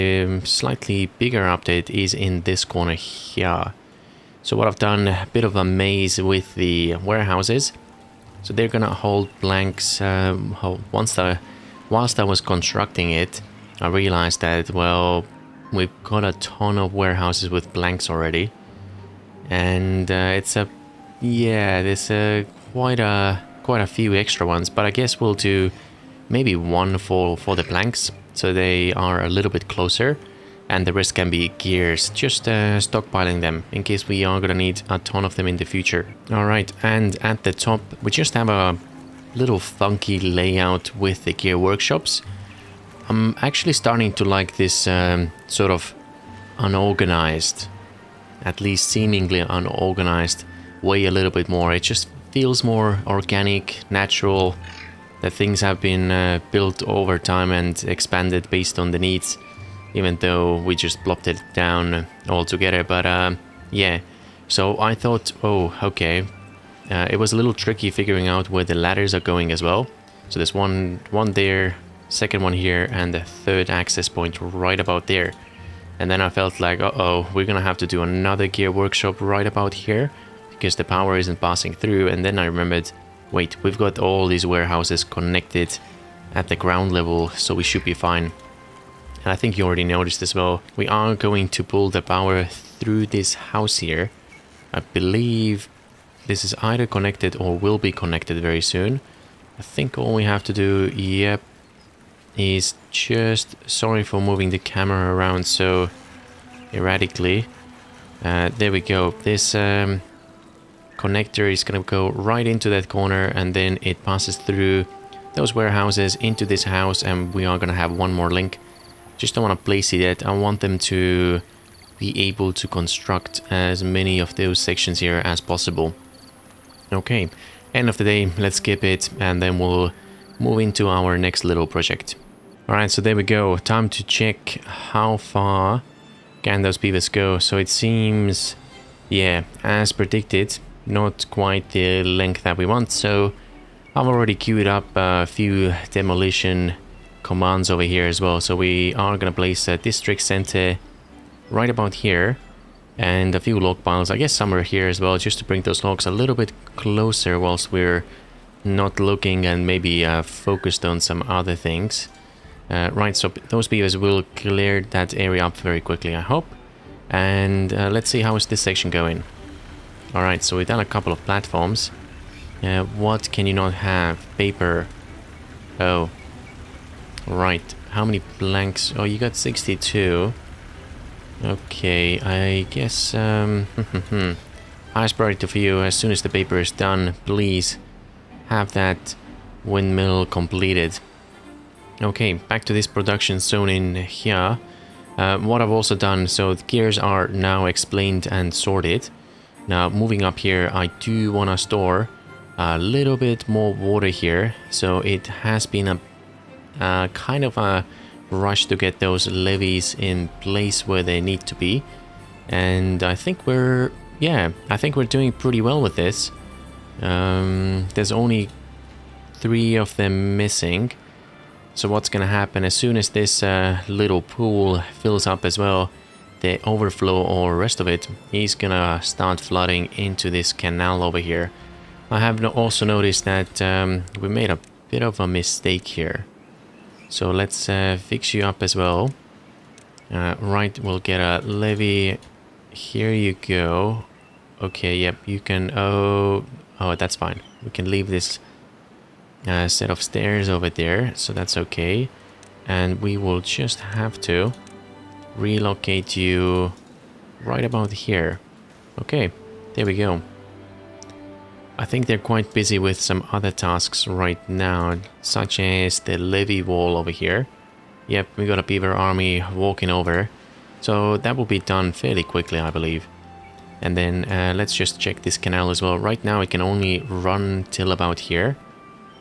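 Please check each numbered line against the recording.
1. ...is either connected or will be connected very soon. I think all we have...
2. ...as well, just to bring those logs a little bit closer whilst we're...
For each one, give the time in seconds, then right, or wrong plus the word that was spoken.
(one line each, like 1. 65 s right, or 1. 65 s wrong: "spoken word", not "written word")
1. 96 s right
2. 154 s right.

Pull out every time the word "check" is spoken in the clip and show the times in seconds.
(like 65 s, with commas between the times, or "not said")
134 s, 274 s.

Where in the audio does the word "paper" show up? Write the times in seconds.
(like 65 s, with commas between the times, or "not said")
174 s, 186 s.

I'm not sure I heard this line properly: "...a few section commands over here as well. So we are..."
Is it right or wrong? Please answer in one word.
wrong.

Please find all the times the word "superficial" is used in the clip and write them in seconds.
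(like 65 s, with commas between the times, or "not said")
not said.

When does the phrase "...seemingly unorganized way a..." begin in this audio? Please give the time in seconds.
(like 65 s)
48 s.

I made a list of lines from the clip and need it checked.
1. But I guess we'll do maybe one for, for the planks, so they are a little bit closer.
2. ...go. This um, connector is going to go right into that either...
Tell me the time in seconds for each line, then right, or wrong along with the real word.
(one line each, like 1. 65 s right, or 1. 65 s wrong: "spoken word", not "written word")
1. 24 s right
2. 108 s wrong: "corner", not "either".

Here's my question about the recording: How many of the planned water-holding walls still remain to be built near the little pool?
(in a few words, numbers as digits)
3.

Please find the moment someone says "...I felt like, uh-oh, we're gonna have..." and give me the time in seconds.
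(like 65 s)
76 s.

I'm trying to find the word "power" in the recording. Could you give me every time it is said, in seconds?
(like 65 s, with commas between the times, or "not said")
80 s, 92 s.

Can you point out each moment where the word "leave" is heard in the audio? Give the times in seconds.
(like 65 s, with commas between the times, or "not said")
247 s.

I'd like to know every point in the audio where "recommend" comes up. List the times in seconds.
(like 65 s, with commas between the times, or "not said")
not said.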